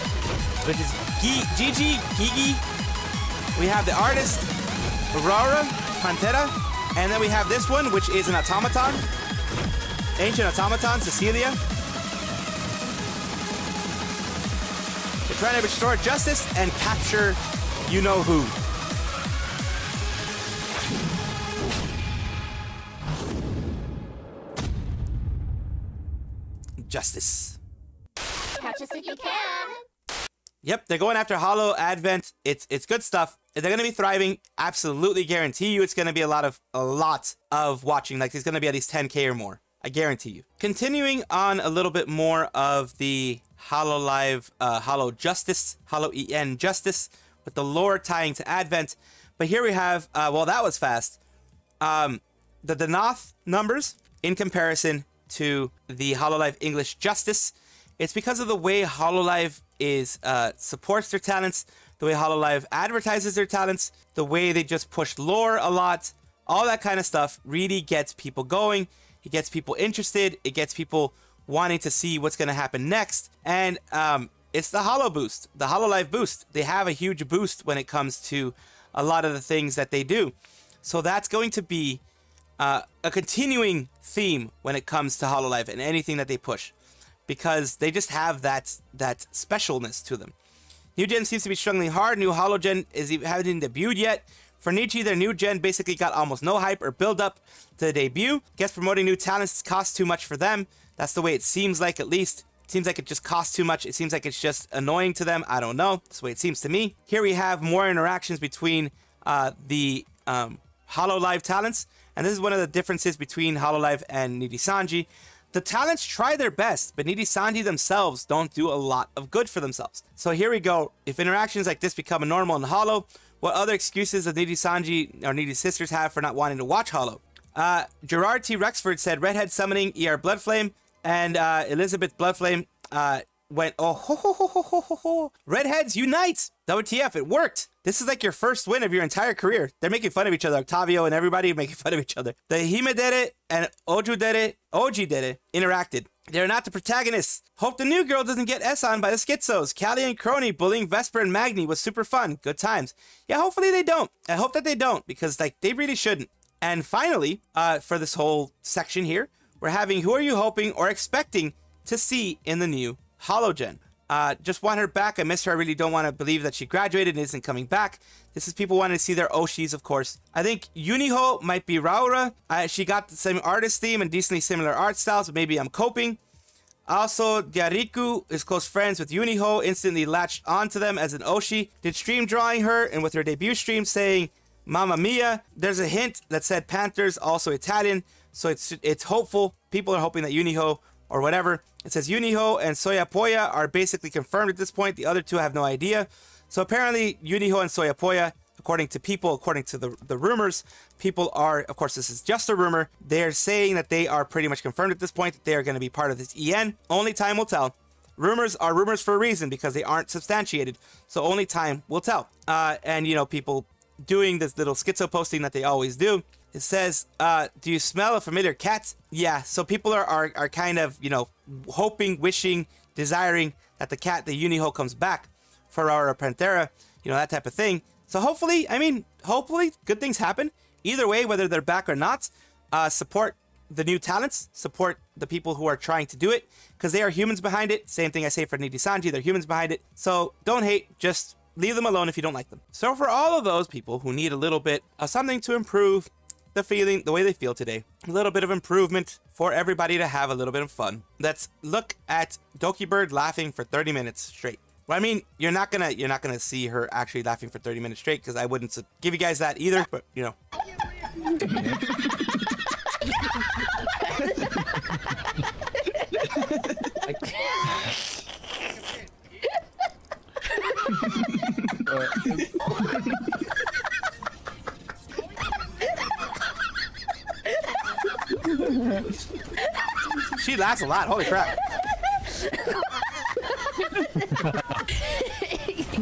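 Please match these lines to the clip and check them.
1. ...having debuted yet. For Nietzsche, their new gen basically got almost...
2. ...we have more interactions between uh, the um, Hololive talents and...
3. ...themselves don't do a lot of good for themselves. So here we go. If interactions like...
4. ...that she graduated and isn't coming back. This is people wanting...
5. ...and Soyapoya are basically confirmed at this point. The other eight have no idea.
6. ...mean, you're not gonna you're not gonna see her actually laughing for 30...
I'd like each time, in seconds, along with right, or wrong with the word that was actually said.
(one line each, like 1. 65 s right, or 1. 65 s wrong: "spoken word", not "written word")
1. 93 s right
2. 107 s right
3. 117 s right
4. 166 s right
5. 192 s wrong: "two", not "eight"
6. 254 s right.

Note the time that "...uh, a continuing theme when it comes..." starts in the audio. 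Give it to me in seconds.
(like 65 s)
82 s.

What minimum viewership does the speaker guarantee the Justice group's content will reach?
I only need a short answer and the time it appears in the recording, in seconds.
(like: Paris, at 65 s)
10k, at 38 s.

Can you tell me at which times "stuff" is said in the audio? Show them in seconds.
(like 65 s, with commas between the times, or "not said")
33 s, 67 s.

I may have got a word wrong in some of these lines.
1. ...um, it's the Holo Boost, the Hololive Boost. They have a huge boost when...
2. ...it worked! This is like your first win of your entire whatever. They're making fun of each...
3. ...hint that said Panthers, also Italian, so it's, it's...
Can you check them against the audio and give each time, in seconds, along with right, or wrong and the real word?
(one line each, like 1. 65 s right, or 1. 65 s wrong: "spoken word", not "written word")
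1. 73 s right
2. 137 s wrong: "career", not "whatever"
3. 185 s right.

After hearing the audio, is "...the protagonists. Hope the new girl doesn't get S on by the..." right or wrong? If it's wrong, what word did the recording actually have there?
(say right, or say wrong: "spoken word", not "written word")
right.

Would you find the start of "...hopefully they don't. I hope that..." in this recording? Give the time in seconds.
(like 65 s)
153 s.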